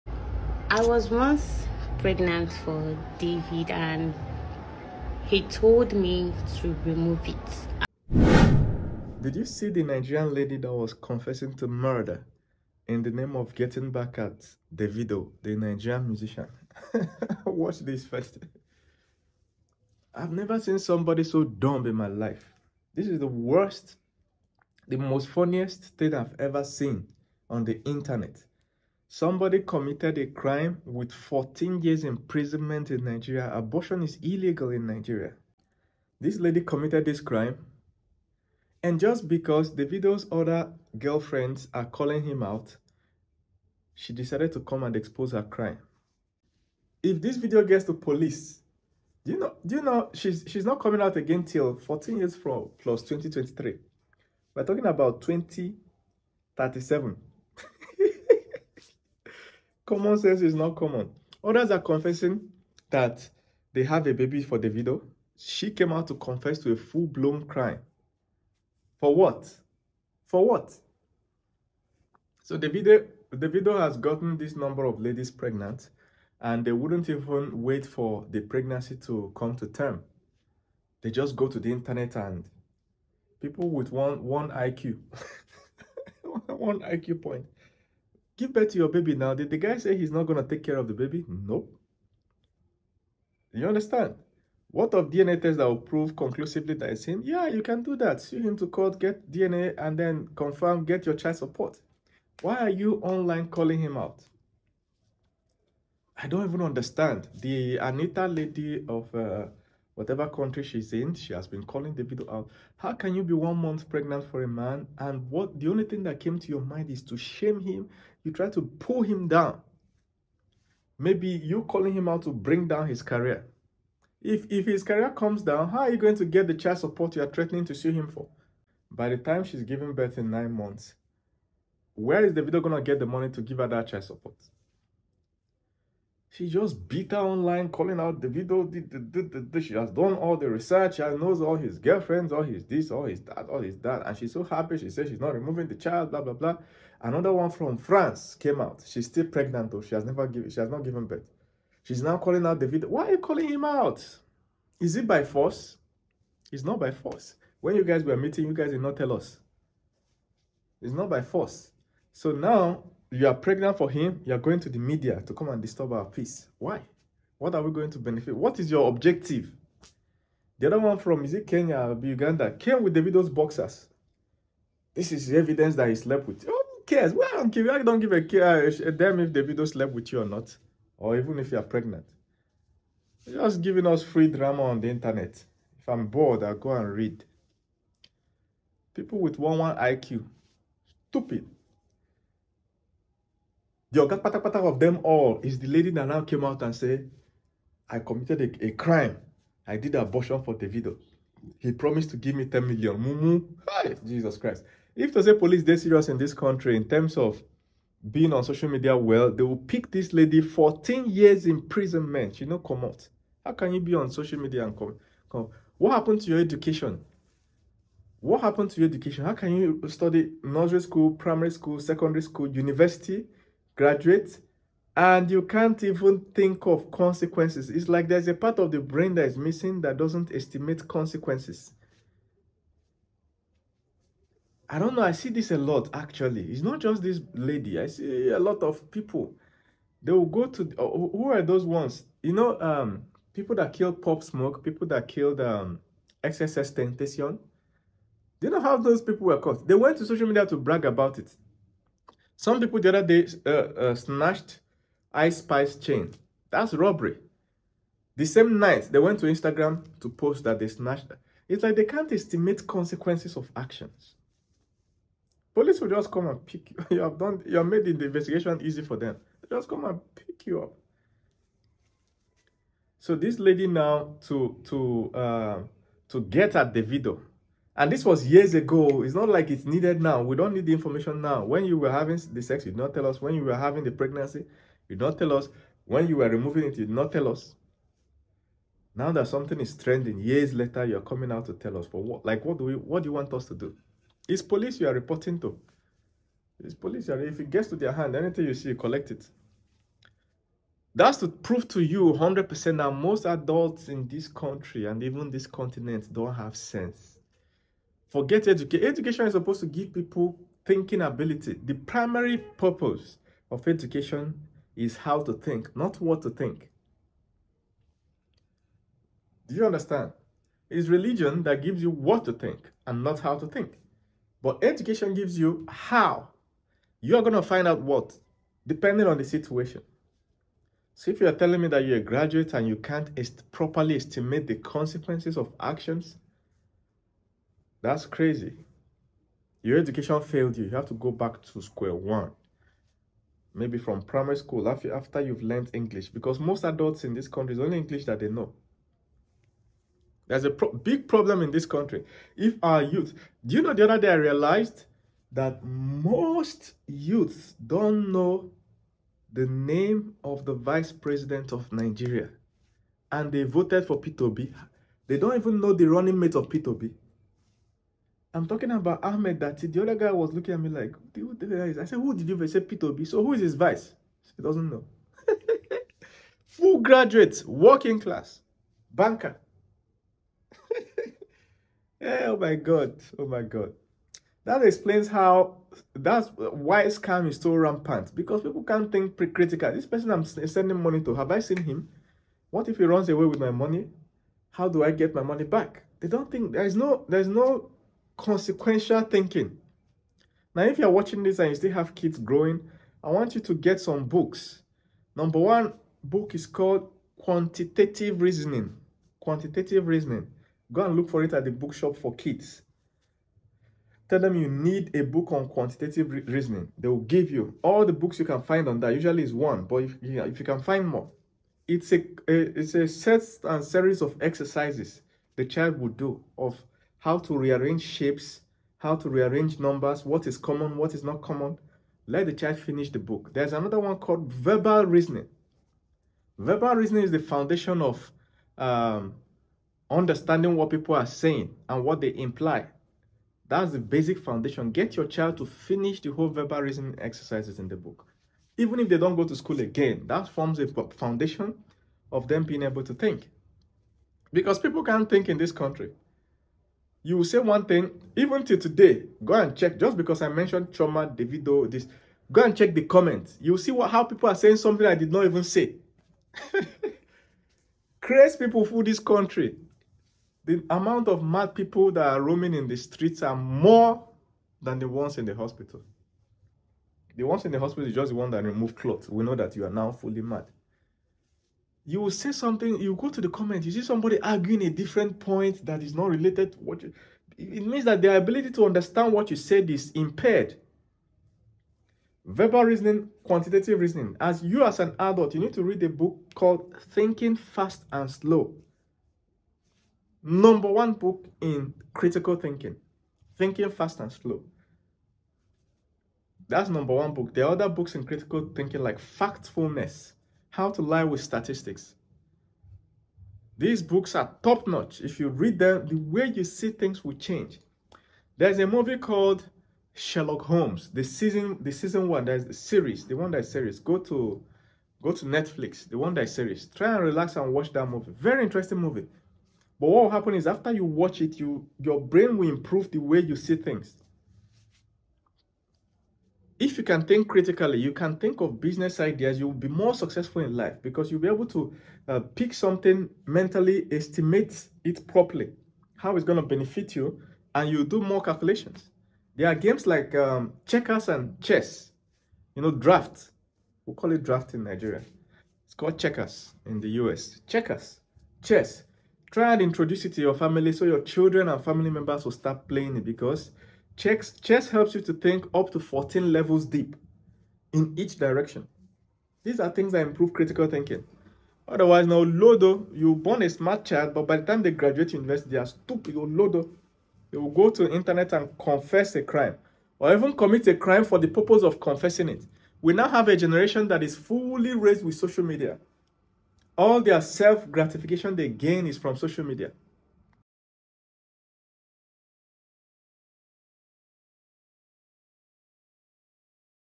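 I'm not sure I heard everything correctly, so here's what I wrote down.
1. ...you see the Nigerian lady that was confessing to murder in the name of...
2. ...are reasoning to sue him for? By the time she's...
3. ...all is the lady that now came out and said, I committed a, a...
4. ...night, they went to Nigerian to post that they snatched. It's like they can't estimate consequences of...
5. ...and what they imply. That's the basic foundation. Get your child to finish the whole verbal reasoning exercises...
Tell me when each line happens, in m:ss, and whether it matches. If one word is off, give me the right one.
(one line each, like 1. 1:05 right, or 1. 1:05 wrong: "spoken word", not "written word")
1. 0:09 right
2. 2:07 wrong: "threatening", not "reasoning"
3. 3:15 right
4. 4:18 wrong: "Instagram", not "Nigerian"
5. 7:21 right.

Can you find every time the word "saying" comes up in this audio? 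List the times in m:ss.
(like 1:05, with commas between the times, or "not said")
7:21, 7:44.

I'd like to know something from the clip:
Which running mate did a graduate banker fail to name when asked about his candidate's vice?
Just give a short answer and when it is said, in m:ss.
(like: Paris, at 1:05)
Ahmed Datti, at 6:09.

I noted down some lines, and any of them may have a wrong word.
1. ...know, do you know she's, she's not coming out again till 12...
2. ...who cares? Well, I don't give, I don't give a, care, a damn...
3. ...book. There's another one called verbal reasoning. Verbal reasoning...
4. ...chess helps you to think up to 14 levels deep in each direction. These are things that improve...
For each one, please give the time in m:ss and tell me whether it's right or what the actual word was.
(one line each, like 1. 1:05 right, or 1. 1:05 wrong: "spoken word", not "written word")
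1. 0:49 wrong: "14", not "12"
2. 2:56 right
3. 7:12 right
4. 9:24 right.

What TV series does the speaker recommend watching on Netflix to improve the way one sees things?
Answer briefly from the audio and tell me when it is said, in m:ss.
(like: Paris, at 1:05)
Sherlock Holmes, at 8:39.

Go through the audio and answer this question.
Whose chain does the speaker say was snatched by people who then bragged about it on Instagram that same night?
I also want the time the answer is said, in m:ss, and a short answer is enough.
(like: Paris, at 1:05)
Ice Spice, at 4:15.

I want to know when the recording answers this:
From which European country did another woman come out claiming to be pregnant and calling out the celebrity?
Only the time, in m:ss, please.
2:27.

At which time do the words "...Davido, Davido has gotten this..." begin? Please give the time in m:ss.
1:12.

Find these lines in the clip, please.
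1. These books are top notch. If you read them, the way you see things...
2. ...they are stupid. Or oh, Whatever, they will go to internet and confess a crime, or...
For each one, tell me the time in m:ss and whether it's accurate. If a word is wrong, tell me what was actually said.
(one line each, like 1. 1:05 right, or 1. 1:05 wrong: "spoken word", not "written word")
1. 8:33 right
2. 9:35 wrong: "Lodo", not "Whatever".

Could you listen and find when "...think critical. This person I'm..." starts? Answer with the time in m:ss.
6:28.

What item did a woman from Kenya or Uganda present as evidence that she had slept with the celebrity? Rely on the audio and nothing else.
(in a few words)
Boxers.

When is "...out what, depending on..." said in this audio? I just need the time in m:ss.
5:27.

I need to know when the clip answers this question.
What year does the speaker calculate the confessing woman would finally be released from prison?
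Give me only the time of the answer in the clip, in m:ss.
0:55.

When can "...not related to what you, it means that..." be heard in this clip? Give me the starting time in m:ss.
8:05.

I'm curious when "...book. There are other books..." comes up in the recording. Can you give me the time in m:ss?
8:27.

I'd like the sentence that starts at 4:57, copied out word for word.
Are, if it gets to their hand, anything you see, you collect it.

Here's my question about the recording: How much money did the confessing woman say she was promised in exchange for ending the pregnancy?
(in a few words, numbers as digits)
10 million.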